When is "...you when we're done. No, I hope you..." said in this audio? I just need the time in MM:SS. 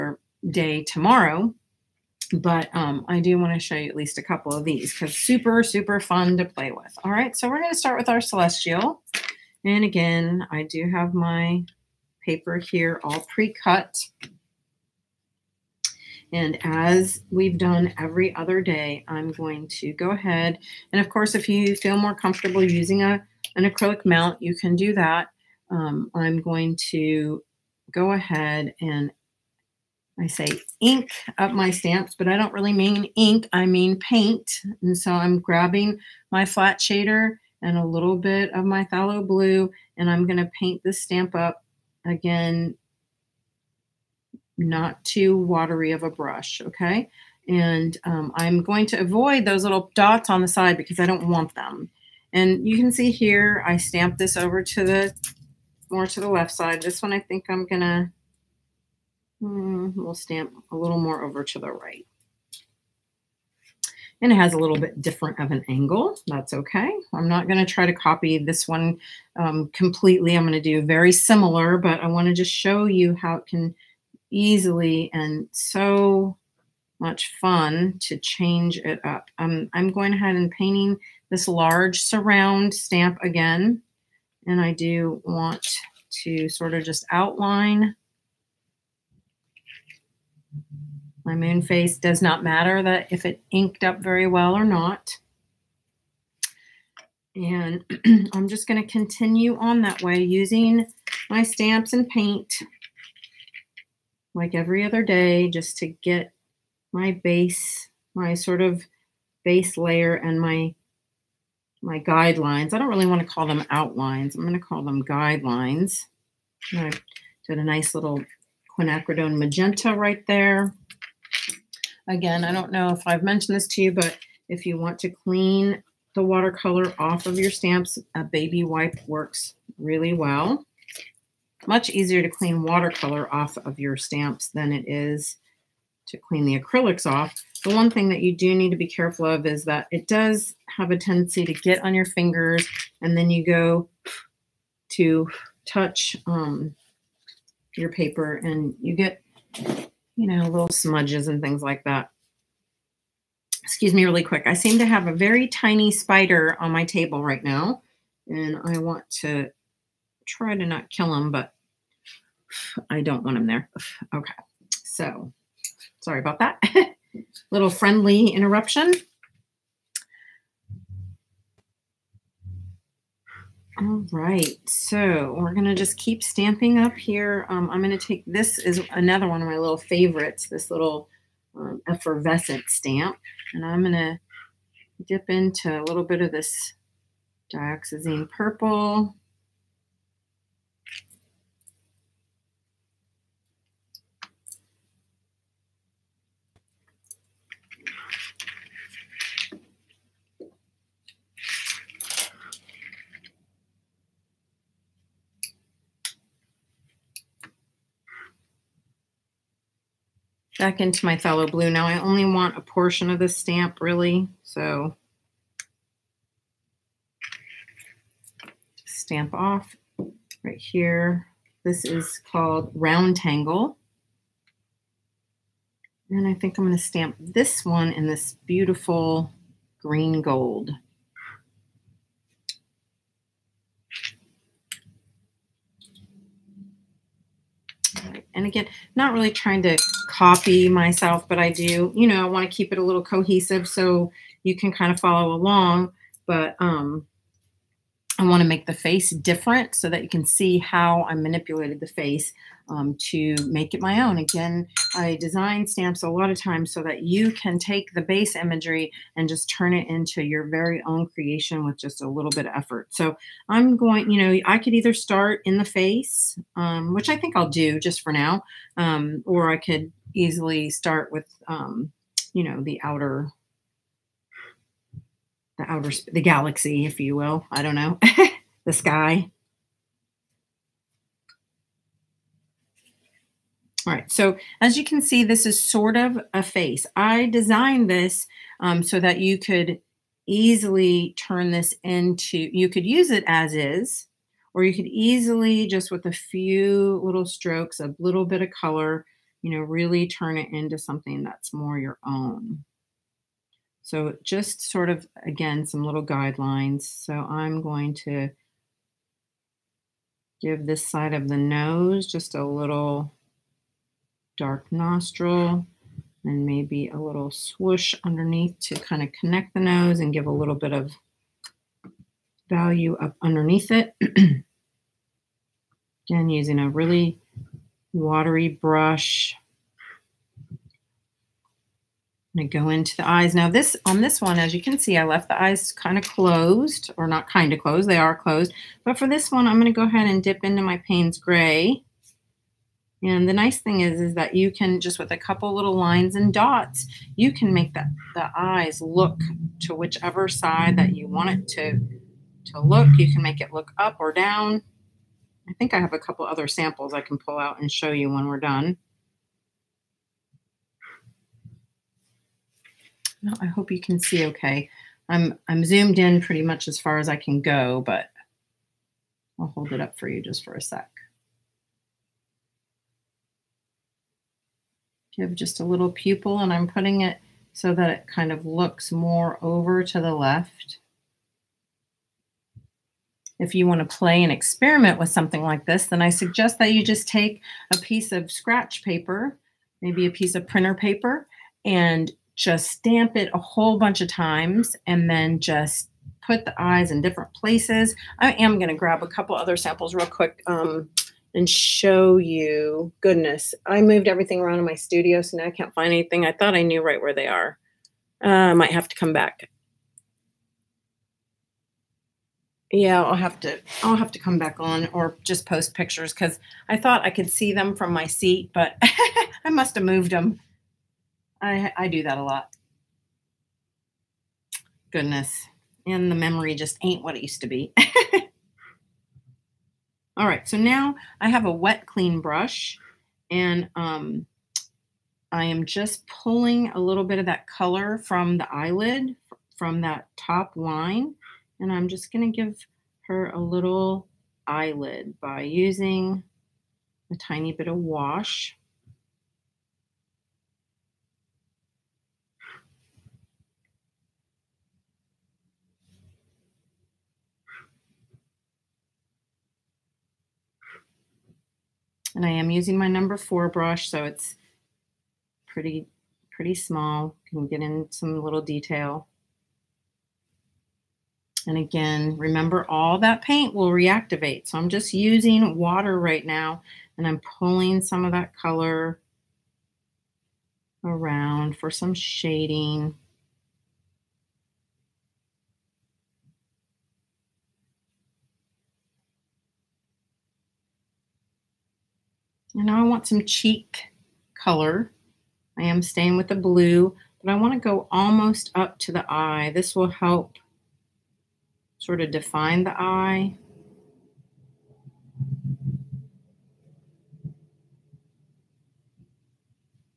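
05:57.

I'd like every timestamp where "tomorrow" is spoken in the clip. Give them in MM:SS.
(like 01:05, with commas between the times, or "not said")
00:00.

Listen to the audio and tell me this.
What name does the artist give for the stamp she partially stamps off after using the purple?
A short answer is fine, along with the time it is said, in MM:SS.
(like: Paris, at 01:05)
Round Tangle, at 03:42.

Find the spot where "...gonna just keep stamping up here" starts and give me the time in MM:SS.
02:55.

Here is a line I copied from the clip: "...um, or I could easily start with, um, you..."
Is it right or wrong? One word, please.
right.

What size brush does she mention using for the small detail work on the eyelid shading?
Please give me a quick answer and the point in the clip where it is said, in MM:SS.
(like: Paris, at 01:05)
number 4, at 07:42.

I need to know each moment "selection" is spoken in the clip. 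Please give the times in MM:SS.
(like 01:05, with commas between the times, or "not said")
not said.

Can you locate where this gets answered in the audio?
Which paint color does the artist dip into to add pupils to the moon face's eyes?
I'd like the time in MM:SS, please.
05:40.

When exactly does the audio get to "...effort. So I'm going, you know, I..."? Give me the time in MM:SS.
04:22.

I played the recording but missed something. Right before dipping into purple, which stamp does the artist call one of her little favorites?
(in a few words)
effervescent stamp.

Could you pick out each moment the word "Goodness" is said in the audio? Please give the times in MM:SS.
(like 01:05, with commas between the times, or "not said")
06:43, 07:04.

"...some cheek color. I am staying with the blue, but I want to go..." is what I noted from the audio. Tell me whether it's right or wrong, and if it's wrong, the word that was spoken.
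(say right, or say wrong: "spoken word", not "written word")
right.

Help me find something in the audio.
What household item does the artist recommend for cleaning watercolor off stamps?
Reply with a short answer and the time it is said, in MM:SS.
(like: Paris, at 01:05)
A baby wipe, at 02:08.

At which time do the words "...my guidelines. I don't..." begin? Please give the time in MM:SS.
01:51.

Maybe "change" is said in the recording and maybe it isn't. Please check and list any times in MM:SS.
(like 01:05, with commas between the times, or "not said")
01:18.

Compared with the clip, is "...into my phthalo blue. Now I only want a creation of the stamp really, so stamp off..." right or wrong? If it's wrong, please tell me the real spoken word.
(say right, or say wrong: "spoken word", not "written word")
wrong: "portion", not "creation".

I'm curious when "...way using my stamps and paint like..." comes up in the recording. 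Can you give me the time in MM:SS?
01:40.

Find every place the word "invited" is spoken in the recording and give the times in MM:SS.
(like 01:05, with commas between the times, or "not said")
not said.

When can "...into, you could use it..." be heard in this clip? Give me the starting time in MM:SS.
04:51.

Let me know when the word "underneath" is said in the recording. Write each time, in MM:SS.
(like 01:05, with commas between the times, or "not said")
05:18, 05:23.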